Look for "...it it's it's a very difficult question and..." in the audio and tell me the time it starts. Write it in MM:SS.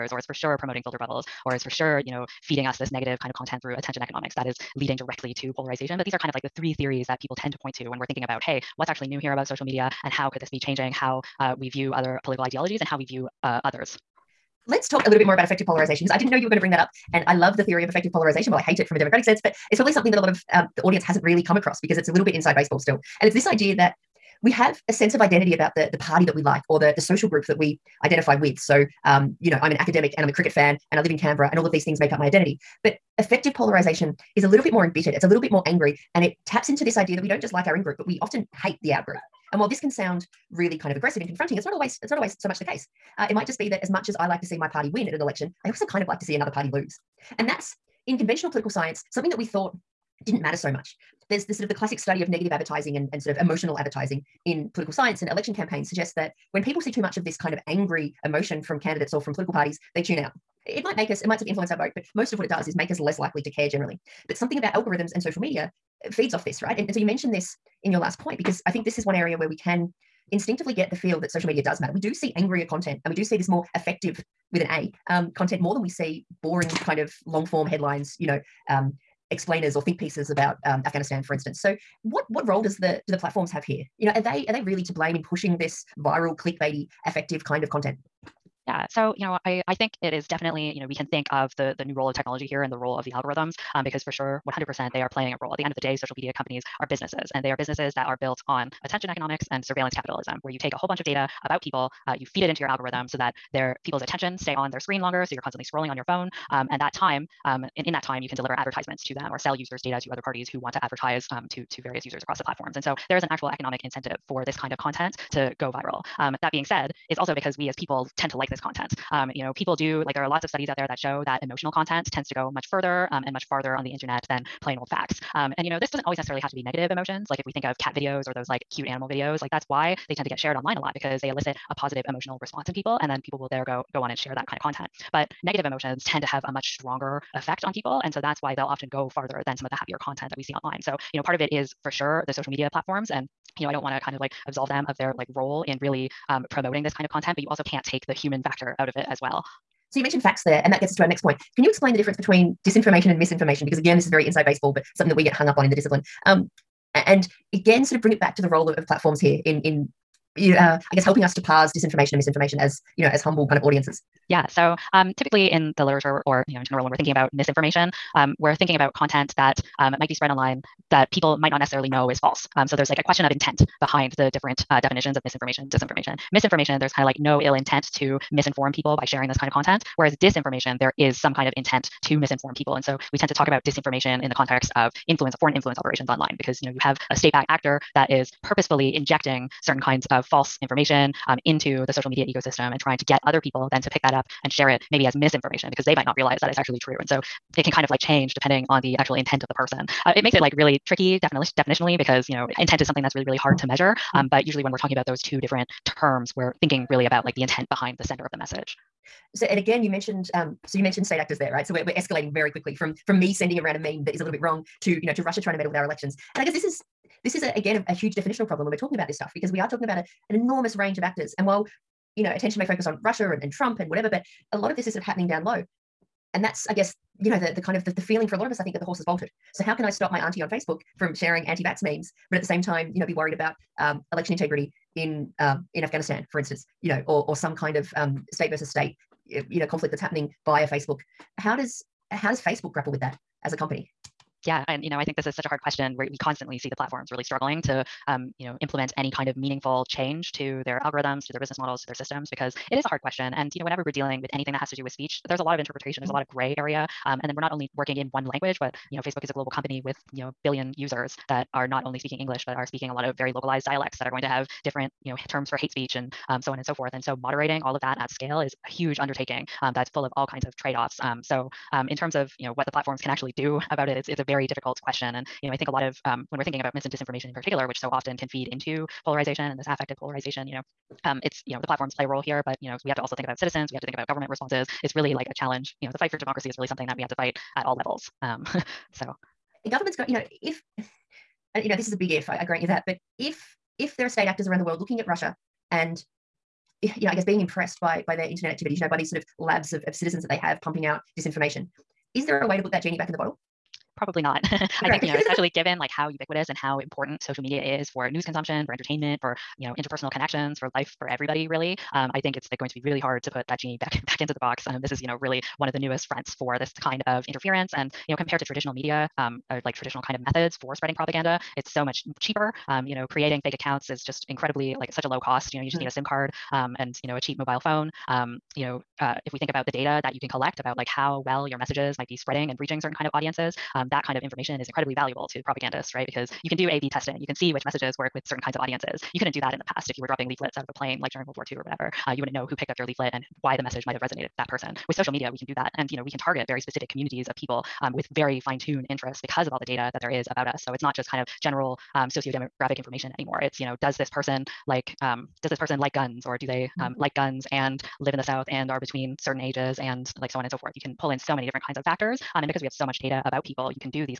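04:33.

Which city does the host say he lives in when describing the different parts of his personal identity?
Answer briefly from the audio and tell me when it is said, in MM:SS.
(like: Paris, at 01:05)
Canberra, at 00:31.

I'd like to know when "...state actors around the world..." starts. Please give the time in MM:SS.
04:54.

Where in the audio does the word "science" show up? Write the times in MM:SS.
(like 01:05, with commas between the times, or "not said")
00:48, 00:54.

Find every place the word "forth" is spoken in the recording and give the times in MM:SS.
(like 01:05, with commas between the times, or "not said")
04:26, 06:00.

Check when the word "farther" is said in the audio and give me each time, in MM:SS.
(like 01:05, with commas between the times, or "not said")
02:03, 02:19.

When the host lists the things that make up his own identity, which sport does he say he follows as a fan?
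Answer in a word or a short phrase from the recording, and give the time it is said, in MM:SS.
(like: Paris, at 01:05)
cricket, at 00:30.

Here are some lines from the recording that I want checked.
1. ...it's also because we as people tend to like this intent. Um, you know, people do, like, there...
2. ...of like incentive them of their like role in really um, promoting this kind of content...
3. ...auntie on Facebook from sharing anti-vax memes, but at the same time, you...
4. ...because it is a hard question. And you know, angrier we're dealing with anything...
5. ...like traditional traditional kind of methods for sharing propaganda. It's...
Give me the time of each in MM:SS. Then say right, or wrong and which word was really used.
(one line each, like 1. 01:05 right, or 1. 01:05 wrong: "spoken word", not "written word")
1. 01:57 wrong: "content", not "intent"
2. 02:24 wrong: "absolve", not "incentive"
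3. 03:50 right
4. 04:12 wrong: "whenever", not "angrier"
5. 05:19 wrong: "spreading", not "sharing".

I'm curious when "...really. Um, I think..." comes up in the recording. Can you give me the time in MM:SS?
05:11.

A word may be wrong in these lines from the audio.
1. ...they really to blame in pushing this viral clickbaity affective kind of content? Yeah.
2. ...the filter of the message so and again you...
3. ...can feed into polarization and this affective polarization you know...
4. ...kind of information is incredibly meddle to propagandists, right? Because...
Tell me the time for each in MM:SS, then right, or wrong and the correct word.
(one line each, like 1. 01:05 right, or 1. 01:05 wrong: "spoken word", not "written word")
1. 01:24 right
2. 03:27 wrong: "sender", not "filter"
3. 04:38 right
4. 05:34 wrong: "valuable", not "meddle".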